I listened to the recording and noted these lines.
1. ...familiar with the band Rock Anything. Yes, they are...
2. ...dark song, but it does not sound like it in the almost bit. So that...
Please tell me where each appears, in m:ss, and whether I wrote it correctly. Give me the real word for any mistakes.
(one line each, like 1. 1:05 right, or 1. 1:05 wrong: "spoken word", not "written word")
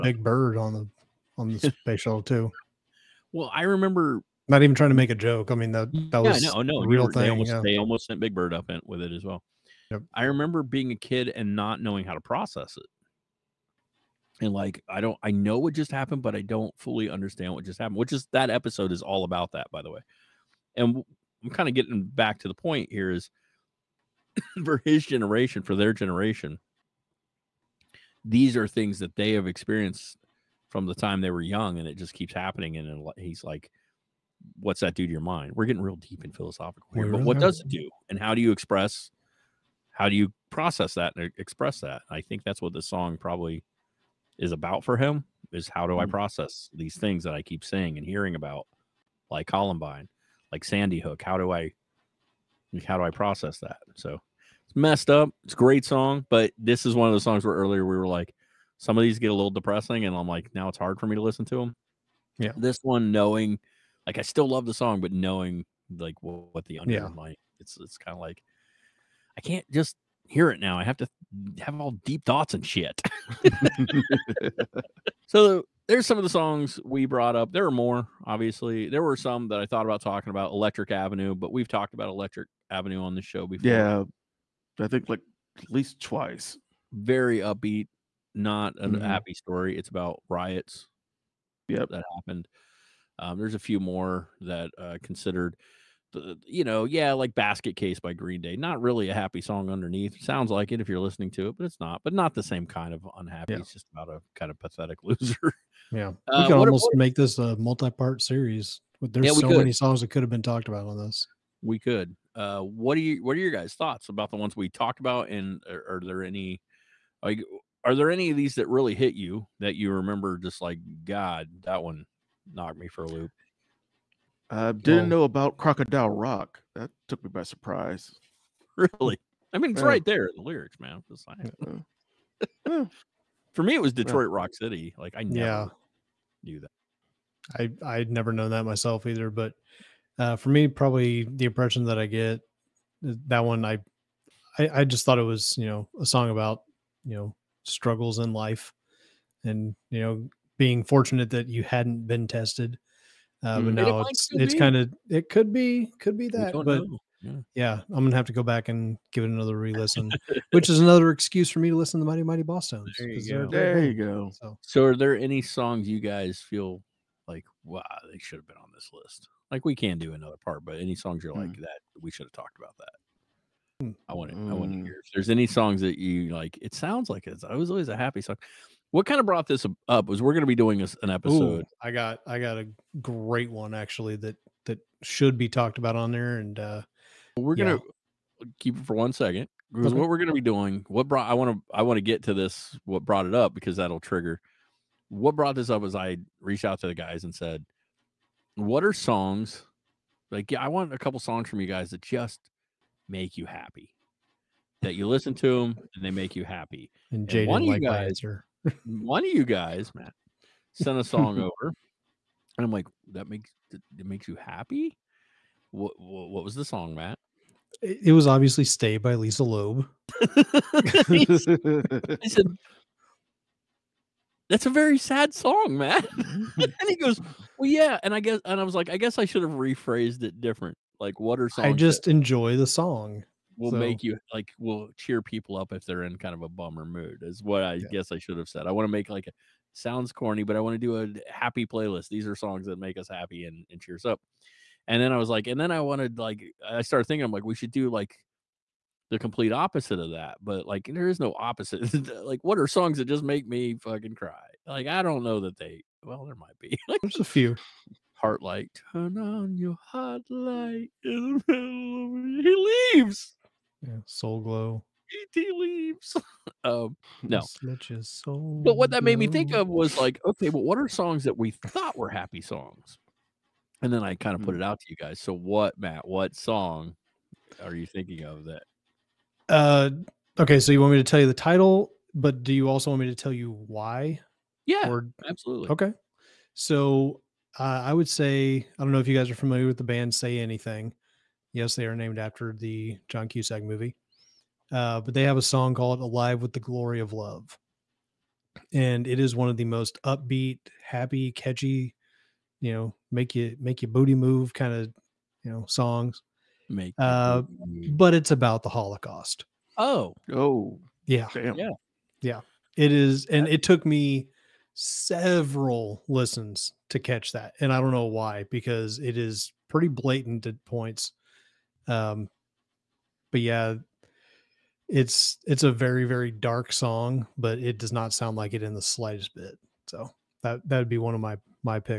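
1. 4:49 wrong: "Say", not "Rock"
2. 5:26 wrong: "slightest", not "almost".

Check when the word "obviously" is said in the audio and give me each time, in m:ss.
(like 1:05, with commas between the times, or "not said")
1:18, 3:38.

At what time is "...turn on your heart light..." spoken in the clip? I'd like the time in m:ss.
4:18.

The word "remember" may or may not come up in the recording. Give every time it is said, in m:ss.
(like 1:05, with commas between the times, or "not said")
0:03, 0:10, 1:59.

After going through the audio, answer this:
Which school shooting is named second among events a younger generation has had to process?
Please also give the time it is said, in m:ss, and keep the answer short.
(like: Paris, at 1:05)
Sandy Hook, at 0:50.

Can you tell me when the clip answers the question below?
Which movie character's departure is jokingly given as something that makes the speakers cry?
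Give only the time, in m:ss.
4:25.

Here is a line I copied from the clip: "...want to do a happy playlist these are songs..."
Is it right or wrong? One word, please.
right.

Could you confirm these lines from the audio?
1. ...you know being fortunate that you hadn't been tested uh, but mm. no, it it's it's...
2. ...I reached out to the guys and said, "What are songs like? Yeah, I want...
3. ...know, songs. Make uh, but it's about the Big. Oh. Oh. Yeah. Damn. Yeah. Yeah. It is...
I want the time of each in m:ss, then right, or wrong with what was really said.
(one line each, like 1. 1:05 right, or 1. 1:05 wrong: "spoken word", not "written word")
1. 2:29 right
2. 3:15 right
3. 5:05 wrong: "Holocaust", not "Big".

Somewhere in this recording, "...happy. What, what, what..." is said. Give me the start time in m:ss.
3:34.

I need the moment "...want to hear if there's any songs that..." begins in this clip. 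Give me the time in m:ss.
2:54.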